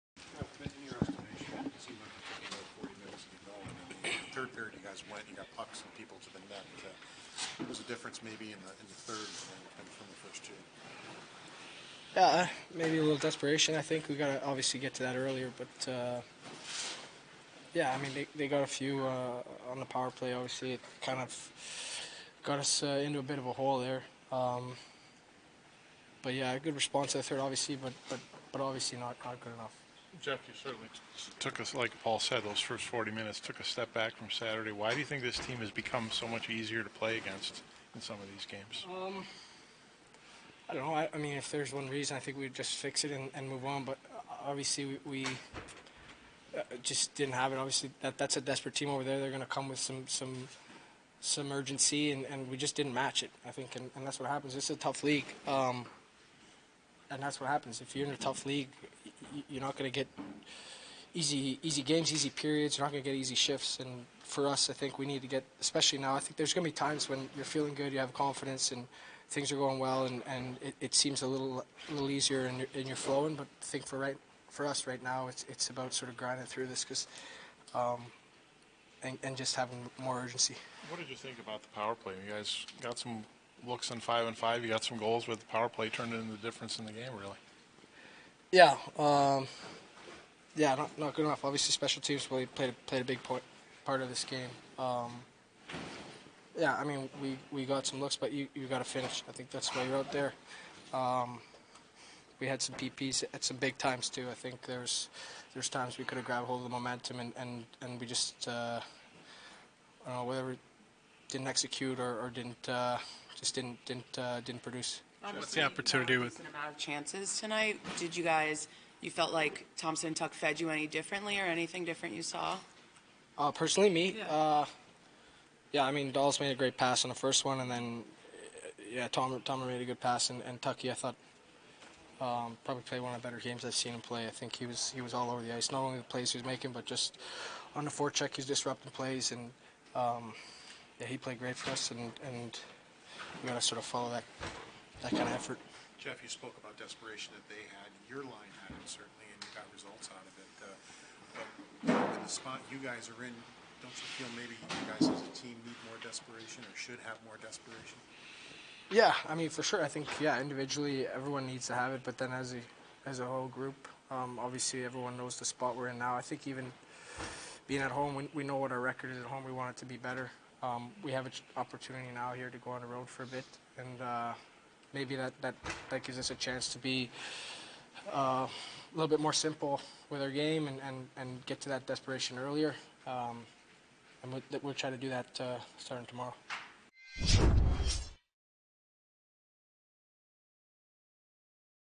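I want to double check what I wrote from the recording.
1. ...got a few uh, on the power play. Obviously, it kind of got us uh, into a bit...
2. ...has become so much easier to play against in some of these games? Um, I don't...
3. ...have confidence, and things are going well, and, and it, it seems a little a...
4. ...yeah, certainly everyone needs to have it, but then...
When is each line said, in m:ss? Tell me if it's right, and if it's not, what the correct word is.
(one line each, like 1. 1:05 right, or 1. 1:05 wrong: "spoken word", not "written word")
1. 0:18 right
2. 0:35 right
3. 1:07 right
4. 2:40 wrong: "individually", not "certainly".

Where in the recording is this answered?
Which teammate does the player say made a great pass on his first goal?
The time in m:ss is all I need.
2:06.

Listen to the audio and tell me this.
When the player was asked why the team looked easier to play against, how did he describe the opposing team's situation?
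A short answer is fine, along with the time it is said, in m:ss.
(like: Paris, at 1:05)
desperate team, at 0:48.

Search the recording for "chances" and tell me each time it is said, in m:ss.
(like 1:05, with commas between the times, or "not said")
1:56, 2:56.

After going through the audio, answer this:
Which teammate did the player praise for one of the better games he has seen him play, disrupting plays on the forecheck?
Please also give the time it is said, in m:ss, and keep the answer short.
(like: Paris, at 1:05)
Tucky, at 2:10.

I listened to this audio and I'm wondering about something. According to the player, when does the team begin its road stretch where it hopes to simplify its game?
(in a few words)
tomorrow.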